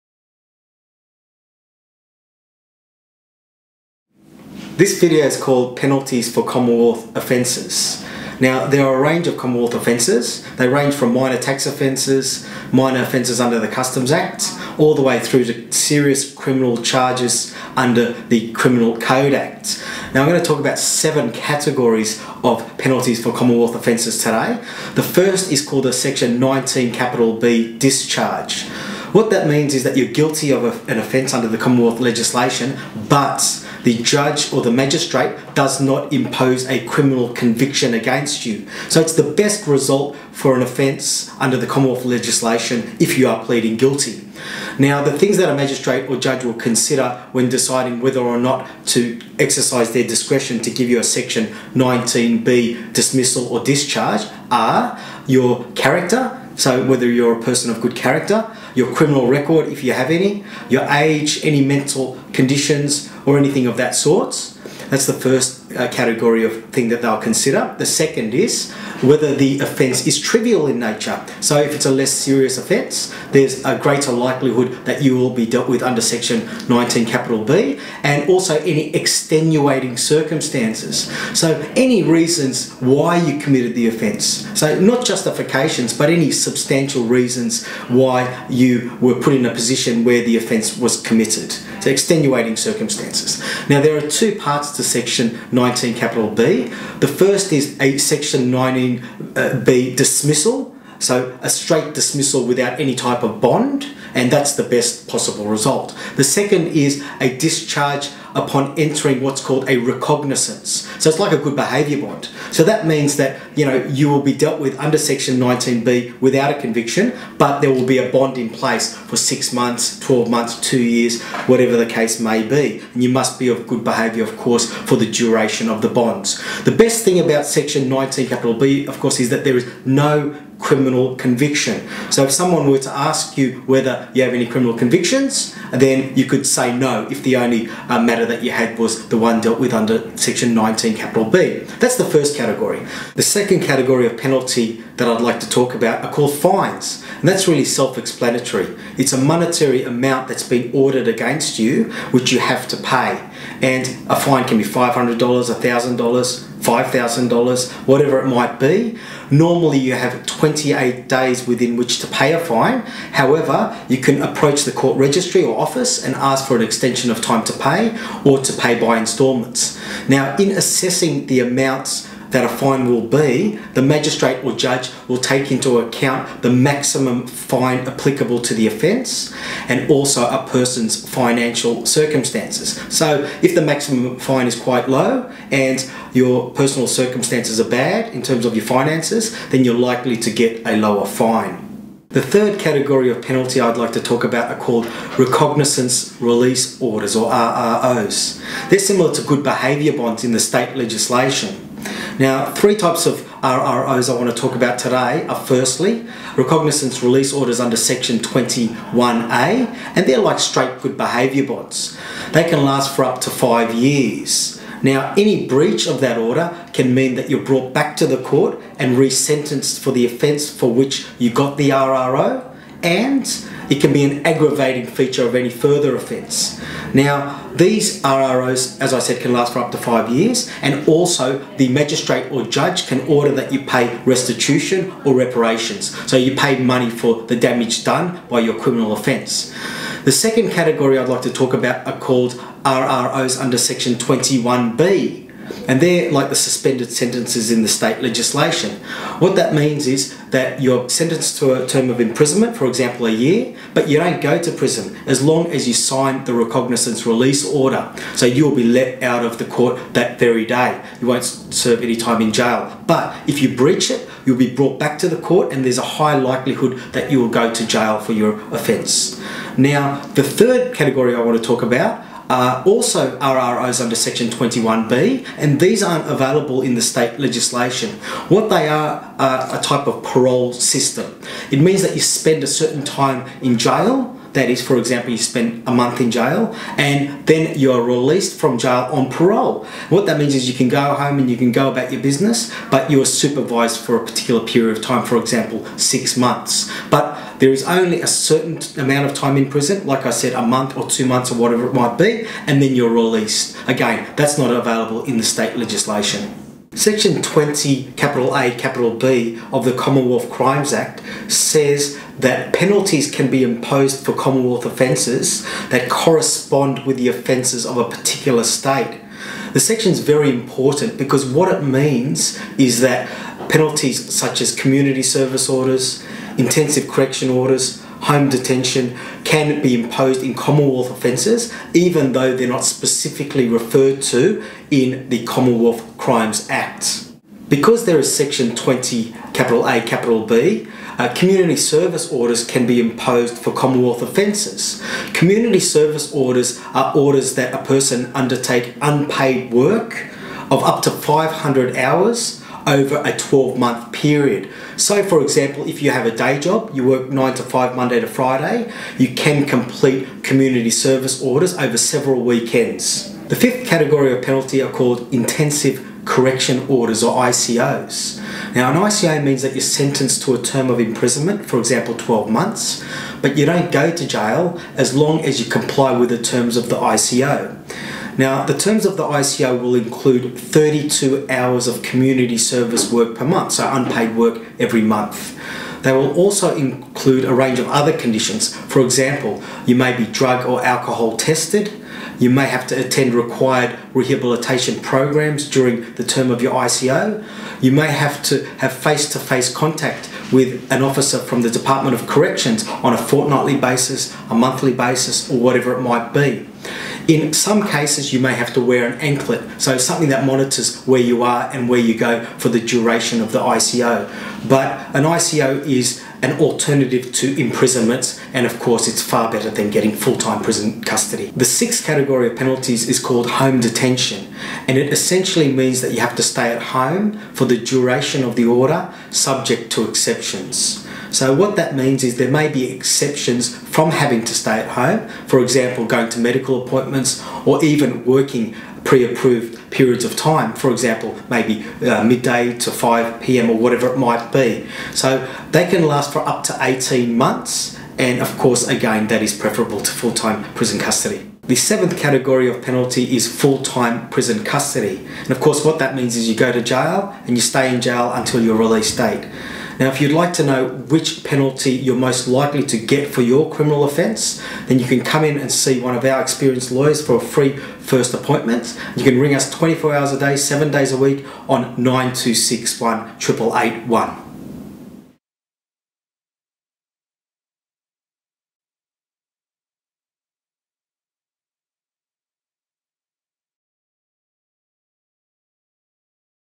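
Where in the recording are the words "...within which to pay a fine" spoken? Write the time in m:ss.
2:41.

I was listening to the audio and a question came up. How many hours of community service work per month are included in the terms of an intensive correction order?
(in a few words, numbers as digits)
32.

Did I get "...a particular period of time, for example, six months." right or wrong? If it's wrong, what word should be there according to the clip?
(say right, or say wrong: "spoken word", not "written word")
right.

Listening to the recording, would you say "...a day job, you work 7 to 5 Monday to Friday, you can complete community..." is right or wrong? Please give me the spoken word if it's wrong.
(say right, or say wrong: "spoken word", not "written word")
wrong: "9", not "7".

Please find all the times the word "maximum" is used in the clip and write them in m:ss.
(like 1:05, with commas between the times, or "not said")
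2:56, 3:03.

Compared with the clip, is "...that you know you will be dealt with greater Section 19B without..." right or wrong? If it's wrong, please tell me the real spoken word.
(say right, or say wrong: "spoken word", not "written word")
wrong: "under", not "greater".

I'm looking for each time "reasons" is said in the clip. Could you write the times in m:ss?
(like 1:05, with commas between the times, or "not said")
1:22, 1:27.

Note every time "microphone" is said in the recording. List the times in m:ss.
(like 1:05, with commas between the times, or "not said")
not said.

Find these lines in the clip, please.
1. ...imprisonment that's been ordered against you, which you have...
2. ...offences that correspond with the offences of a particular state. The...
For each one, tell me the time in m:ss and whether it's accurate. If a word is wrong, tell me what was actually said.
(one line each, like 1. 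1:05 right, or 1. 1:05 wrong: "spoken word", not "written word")
1. 2:29 wrong: "amount", not "imprisonment"
2. 5:14 right.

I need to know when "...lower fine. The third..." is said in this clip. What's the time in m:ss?
3:10.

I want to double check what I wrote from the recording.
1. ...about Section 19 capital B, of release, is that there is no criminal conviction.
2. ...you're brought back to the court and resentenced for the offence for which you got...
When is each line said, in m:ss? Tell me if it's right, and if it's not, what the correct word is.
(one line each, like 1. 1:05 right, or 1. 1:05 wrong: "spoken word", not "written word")
1. 2:07 wrong: "course", not "release"
2. 3:37 right.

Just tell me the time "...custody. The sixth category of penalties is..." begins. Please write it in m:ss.
7:00.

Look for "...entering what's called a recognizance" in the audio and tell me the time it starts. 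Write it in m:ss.
1:48.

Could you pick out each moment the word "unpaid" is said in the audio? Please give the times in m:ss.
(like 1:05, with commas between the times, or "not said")
5:48, 6:23.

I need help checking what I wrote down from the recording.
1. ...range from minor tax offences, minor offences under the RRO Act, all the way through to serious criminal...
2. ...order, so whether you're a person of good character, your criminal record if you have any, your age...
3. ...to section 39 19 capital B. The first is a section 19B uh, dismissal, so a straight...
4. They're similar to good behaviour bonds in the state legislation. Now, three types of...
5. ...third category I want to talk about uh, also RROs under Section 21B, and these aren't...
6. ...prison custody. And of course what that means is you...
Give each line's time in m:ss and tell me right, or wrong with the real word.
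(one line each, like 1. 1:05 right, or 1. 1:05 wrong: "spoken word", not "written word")
1. 0:10 wrong: "Customs", not "RRO"
2. 0:55 wrong: "character", not "order"
3. 1:34 wrong: "19", not "39"
4. 3:18 right
5. 4:30 right
6. 7:34 right.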